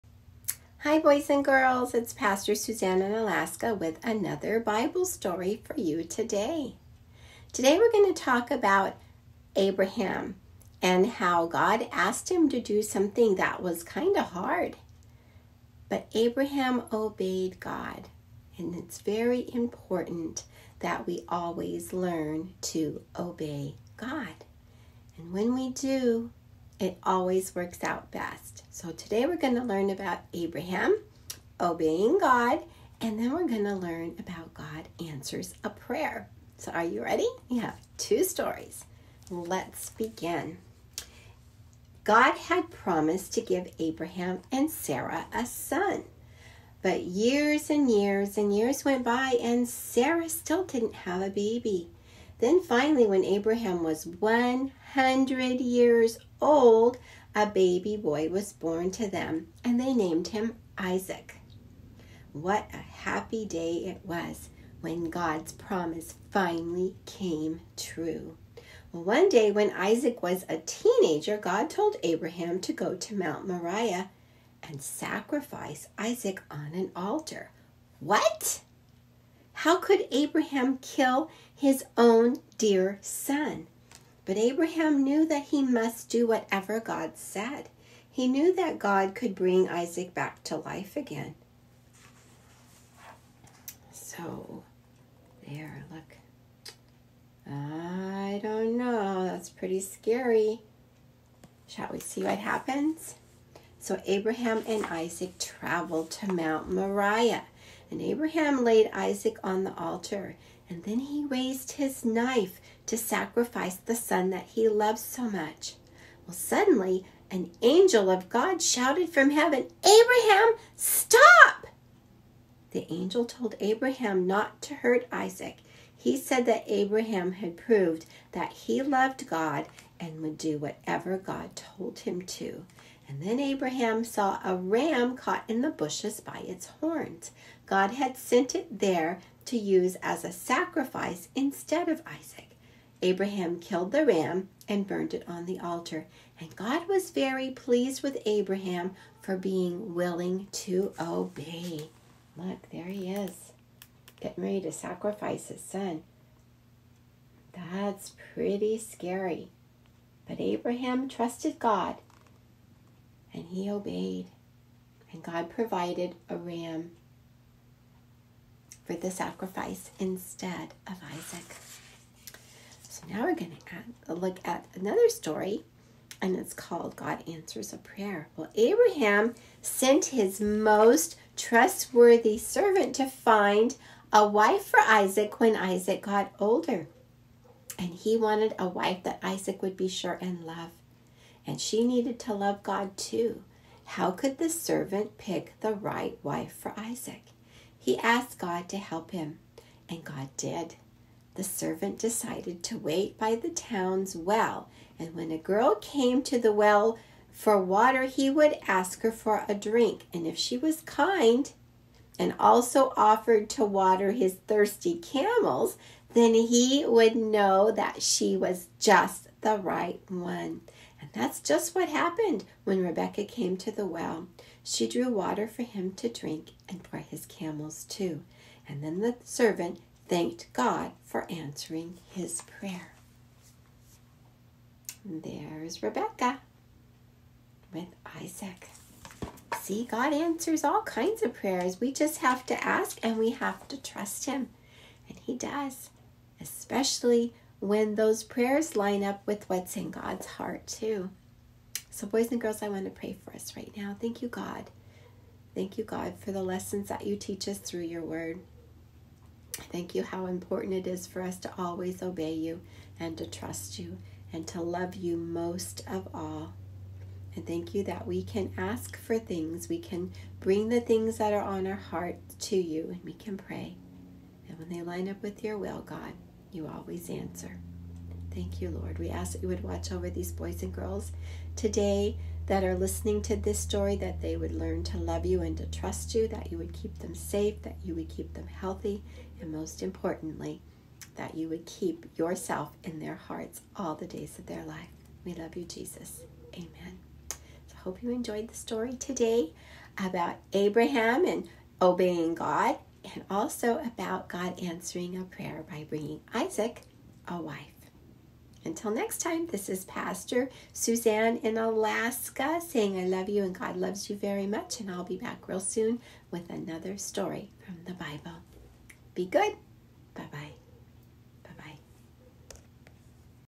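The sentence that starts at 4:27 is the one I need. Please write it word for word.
And thank you that we can ask for things.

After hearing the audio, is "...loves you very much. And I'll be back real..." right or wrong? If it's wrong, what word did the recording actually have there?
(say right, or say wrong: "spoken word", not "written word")
right.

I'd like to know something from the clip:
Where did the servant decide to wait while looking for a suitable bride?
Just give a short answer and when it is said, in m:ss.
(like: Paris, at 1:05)
The town's well, at 3:23.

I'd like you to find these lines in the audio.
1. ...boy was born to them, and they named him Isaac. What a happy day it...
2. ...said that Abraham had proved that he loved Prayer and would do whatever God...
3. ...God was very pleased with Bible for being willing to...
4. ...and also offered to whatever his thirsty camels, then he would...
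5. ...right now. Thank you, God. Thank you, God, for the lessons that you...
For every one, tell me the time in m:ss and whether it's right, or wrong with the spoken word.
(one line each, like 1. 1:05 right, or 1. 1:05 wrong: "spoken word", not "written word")
1. 0:57 right
2. 2:06 wrong: "God", not "Prayer"
3. 2:26 wrong: "Abraham", not "Bible"
4. 3:32 wrong: "water", not "whatever"
5. 4:13 right.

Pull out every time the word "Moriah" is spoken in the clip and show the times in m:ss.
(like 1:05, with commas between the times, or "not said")
1:13, 1:46.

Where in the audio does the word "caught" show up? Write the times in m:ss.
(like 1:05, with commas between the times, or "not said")
2:15.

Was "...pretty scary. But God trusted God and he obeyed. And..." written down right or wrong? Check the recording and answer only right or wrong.
wrong.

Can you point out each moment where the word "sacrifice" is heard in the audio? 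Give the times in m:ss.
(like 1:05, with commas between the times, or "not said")
1:14, 1:52, 2:20, 2:34, 2:49.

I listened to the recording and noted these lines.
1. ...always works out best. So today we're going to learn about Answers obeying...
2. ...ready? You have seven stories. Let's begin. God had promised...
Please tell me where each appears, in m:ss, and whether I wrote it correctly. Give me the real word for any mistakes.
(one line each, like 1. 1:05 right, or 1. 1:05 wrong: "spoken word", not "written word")
1. 0:27 wrong: "Abraham", not "Answers"
2. 0:37 wrong: "two", not "seven".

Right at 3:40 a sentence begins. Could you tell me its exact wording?
And that's just what happened when Rebecca came to the well.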